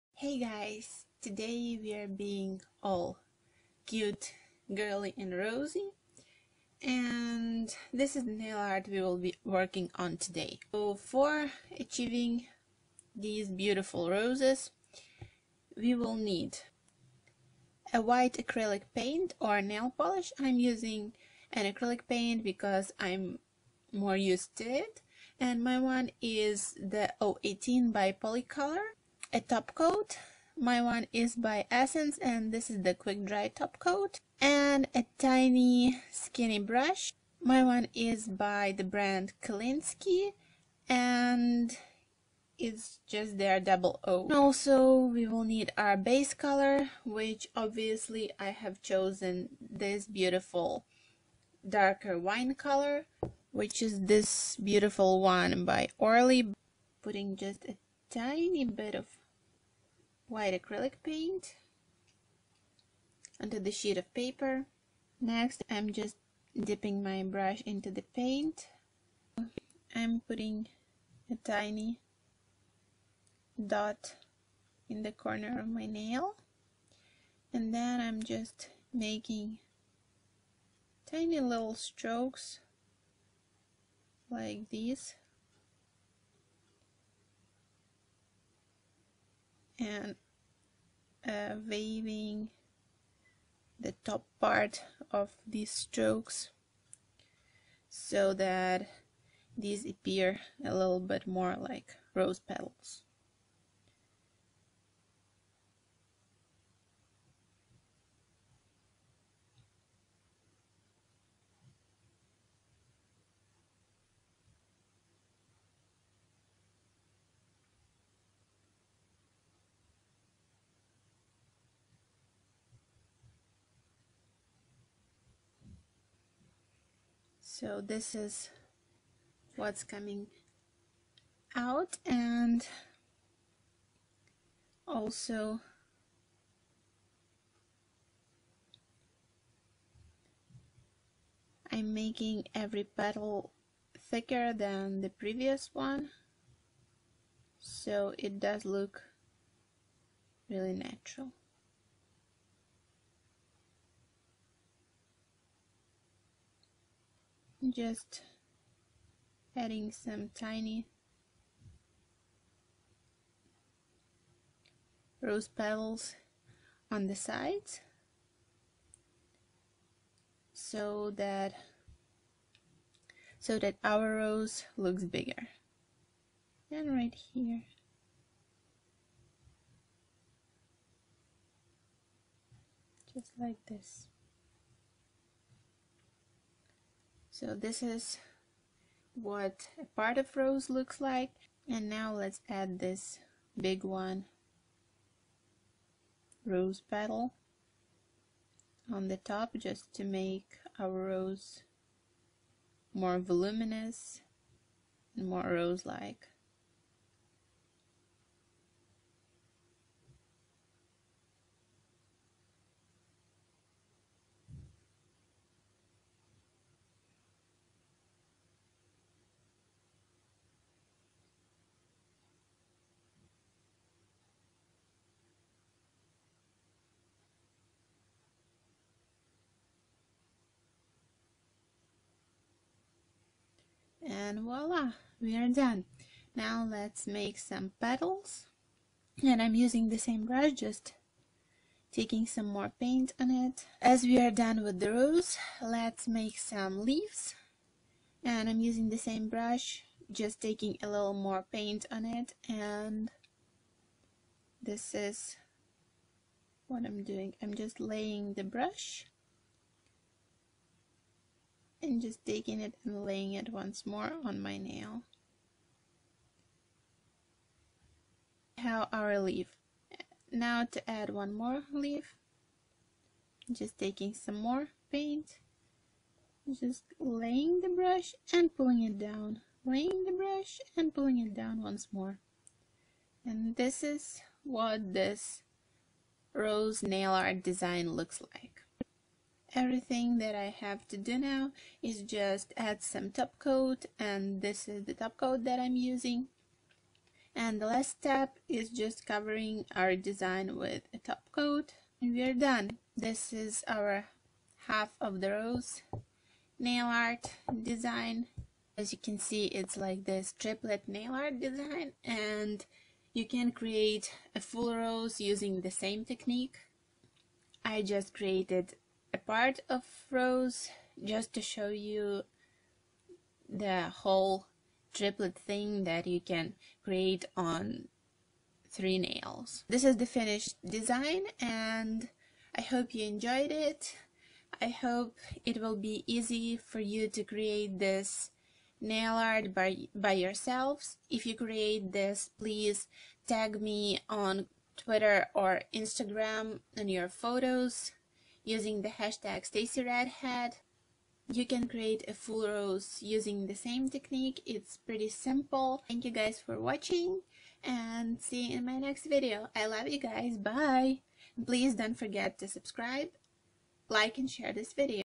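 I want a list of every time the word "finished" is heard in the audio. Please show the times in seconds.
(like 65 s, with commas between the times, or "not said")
330 s.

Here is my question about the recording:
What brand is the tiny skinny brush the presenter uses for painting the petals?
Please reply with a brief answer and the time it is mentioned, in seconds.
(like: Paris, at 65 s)
Kolinsky, at 39 s.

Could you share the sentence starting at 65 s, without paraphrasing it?
Next, I'm just dipping my brush into the paint.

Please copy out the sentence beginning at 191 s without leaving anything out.
And now let's add this big one, rose petal, on the top just to make our rose more voluminous and more rose-like.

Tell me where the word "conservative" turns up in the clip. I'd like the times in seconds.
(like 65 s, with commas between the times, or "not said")
not said.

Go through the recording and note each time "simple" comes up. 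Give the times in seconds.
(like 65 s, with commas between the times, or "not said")
355 s.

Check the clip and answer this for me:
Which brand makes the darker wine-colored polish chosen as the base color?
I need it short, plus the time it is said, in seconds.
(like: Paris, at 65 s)
Orly, at 55 s.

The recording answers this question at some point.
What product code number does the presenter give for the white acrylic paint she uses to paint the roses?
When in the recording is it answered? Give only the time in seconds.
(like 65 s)
27 s.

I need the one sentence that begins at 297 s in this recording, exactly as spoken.
And the last step is just covering our design with a top coat.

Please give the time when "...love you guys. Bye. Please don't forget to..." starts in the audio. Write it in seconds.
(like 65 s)
359 s.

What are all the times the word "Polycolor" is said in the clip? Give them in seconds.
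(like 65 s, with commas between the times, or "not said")
28 s.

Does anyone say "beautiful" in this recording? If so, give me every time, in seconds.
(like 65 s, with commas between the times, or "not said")
13 s, 50 s, 54 s.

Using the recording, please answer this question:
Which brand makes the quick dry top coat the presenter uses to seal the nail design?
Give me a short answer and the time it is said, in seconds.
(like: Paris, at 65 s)
Essence, at 31 s.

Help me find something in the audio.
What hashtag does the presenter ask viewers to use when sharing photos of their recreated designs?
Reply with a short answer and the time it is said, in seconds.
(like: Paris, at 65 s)
StacyRedhead, at 349 s.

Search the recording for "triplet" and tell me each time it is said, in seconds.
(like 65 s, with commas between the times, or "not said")
310 s, 324 s.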